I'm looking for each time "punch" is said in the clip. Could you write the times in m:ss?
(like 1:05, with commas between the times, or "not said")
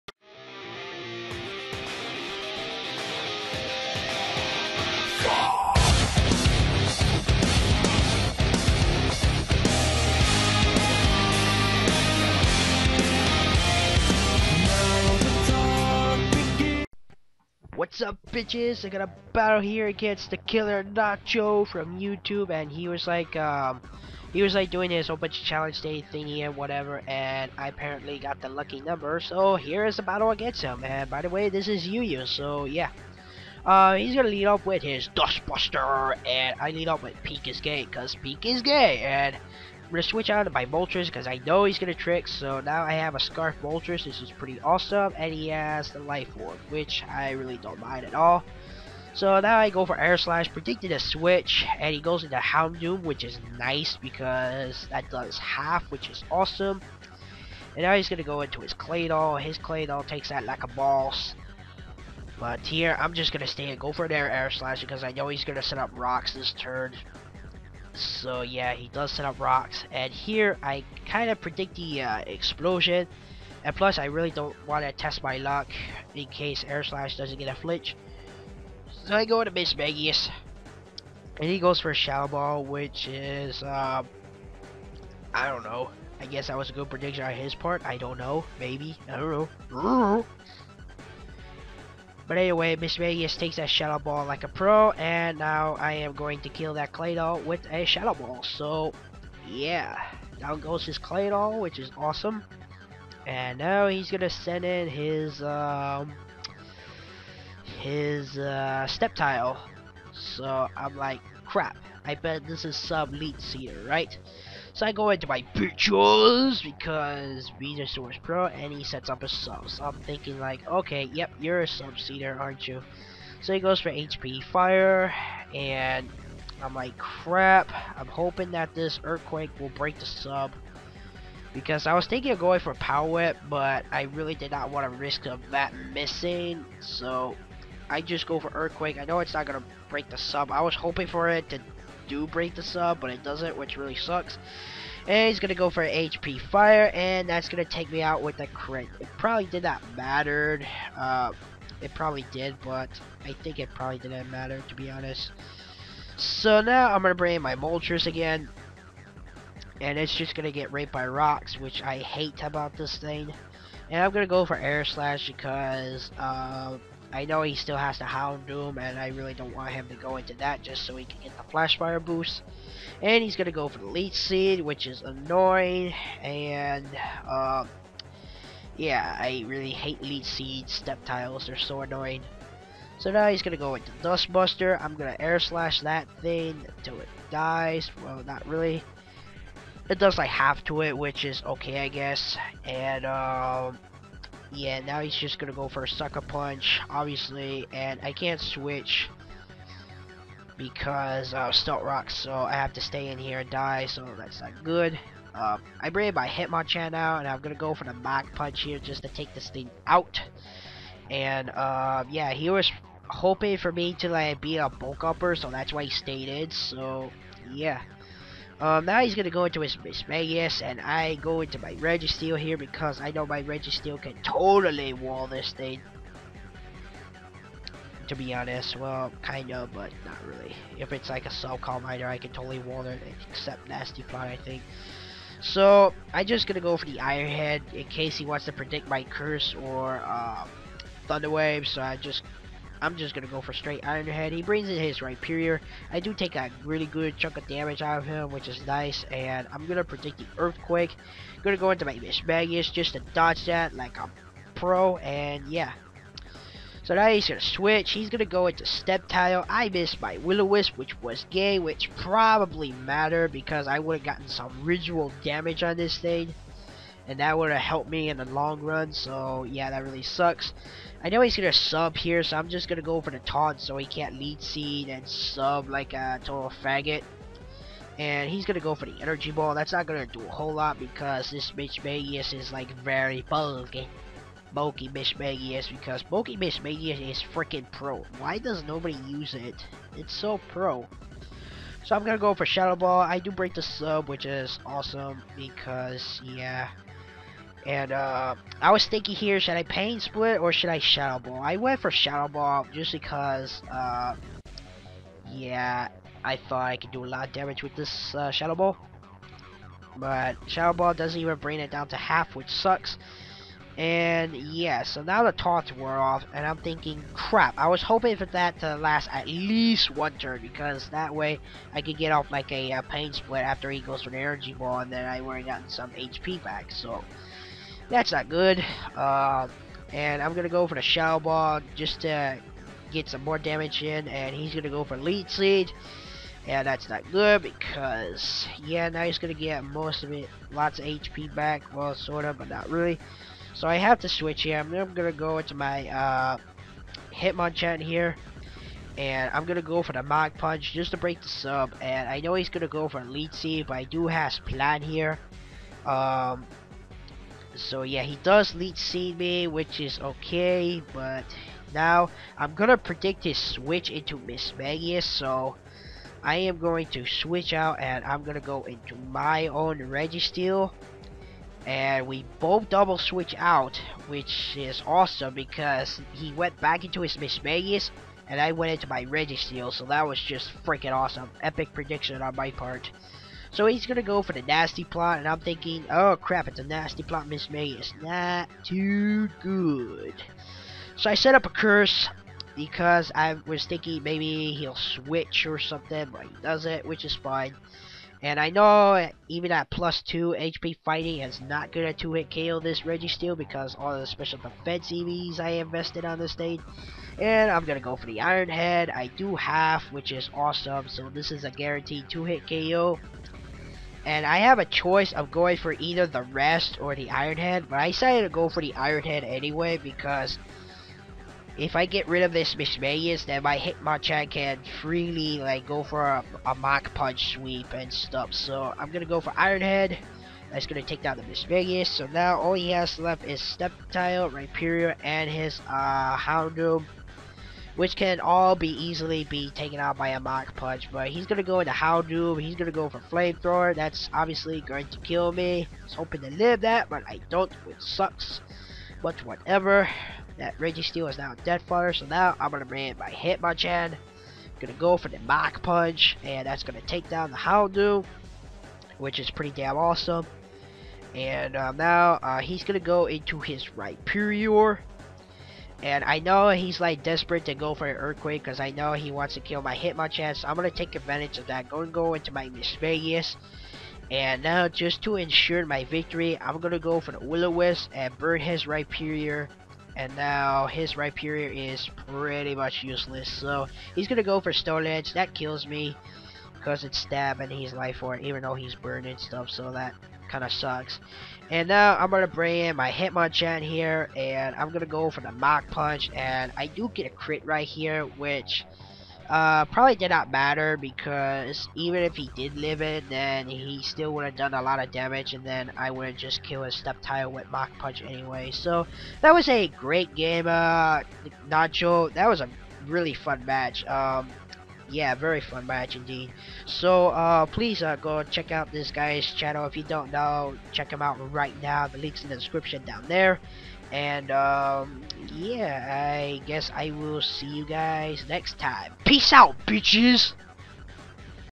3:16, 3:28, 5:50, 7:06, 7:20, 7:35, 8:15, 8:27.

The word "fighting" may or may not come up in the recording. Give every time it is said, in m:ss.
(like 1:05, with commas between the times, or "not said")
6:40.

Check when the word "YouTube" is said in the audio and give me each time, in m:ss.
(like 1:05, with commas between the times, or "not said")
0:21.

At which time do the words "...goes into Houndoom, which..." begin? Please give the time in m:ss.
0:51.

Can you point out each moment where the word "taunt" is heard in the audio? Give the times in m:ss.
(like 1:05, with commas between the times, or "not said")
4:33, 5:15.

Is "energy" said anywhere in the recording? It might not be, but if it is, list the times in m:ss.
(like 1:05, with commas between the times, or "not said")
4:39, 5:24.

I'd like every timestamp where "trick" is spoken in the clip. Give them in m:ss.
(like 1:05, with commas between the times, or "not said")
0:41.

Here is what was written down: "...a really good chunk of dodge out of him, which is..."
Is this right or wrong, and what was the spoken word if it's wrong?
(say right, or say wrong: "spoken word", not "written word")
wrong: "damage", not "dodge".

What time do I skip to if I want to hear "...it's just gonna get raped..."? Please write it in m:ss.
2:39.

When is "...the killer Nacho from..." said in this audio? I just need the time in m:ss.
0:20.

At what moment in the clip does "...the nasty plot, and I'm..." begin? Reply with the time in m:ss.
6:24.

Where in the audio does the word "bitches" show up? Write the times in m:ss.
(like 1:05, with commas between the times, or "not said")
0:18, 8:49.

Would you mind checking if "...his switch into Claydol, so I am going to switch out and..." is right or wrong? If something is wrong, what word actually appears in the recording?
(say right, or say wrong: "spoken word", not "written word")
wrong: "Mismagius", not "Claydol".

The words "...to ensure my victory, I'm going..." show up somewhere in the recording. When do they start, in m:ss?
7:55.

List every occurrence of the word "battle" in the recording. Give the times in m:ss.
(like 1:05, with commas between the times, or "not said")
0:19, 0:30.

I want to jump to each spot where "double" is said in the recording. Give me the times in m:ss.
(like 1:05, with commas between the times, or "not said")
6:12.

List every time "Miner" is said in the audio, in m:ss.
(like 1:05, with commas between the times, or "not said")
3:51.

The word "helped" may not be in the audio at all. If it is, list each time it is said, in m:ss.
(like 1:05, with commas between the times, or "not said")
4:27.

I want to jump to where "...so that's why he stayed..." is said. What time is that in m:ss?
3:35.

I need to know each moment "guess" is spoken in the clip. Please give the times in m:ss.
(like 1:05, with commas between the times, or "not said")
1:26, 3:11, 8:46.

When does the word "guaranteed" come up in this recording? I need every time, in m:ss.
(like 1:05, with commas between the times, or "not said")
6:51.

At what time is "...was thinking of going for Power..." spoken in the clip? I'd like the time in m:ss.
2:11.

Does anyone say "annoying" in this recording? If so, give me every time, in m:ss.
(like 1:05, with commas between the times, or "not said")
2:55, 3:01.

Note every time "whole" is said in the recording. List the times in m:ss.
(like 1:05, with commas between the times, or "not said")
0:25, 4:40.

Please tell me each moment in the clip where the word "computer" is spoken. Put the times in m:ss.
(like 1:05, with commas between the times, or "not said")
not said.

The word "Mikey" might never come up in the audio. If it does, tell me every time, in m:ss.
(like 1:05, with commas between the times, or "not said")
not said.